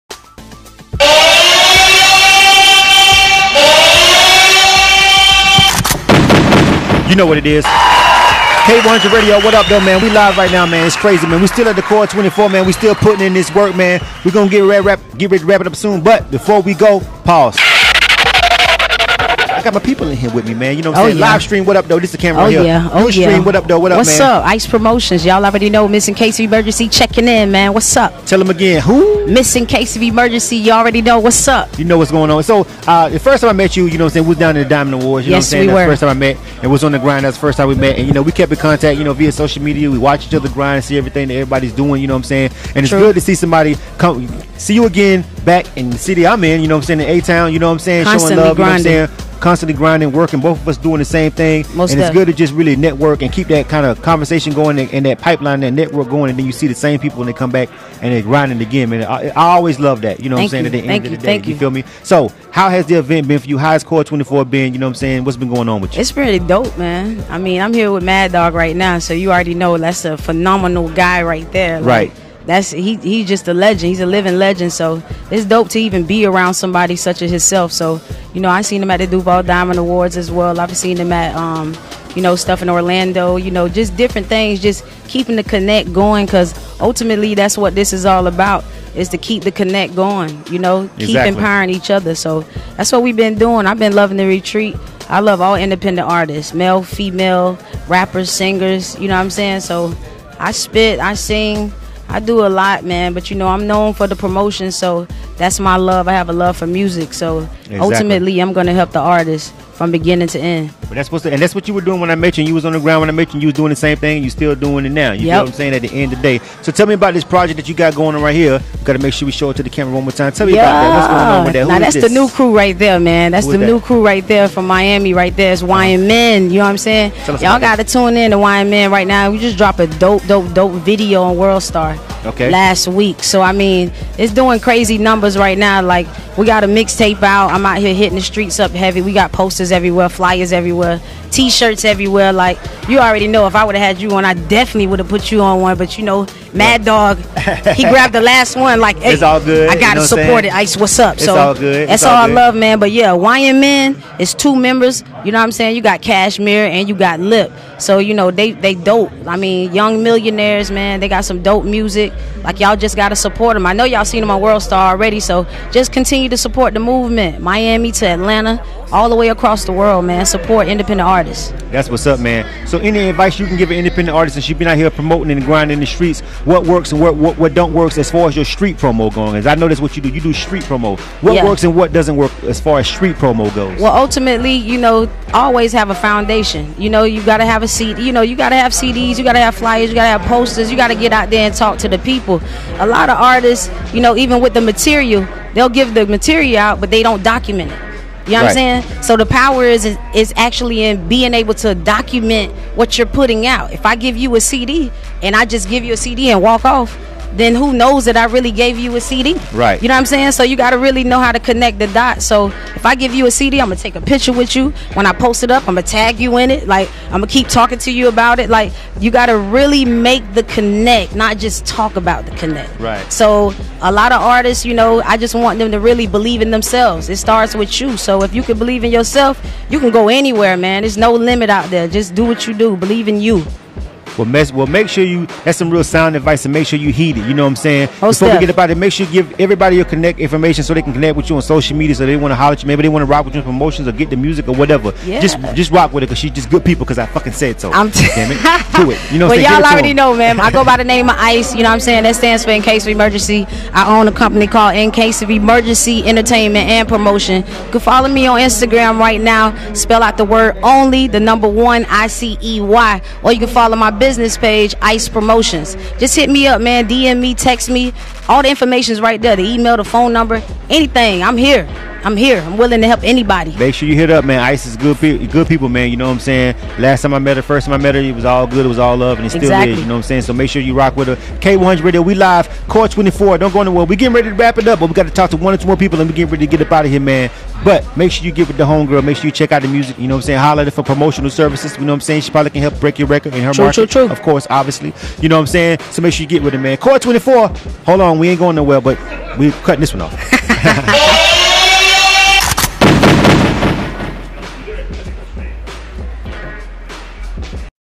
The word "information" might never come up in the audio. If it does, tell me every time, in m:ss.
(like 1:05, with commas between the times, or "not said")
4:00, 4:28.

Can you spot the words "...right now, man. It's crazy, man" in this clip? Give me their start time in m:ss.
0:10.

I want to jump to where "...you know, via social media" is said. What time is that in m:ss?
0:38.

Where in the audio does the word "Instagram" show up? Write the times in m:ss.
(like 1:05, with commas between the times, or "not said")
4:18.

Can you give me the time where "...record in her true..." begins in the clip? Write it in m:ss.
4:53.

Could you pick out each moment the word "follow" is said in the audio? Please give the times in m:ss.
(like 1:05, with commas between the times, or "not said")
4:17, 4:23.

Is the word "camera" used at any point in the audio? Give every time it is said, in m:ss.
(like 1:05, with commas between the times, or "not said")
0:22, 1:59.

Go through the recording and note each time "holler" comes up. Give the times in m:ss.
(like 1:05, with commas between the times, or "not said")
4:02, 4:50.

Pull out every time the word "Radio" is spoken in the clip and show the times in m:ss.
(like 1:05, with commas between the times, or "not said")
0:09, 4:41.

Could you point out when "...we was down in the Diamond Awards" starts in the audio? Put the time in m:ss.
0:34.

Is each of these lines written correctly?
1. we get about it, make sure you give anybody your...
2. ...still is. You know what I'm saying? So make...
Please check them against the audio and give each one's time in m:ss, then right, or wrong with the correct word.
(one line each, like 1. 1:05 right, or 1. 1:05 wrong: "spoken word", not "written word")
1. 3:58 wrong: "everybody", not "anybody"
2. 4:39 right.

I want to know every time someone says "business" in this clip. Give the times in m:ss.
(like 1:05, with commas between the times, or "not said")
4:24.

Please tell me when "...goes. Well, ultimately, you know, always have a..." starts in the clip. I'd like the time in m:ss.
3:03.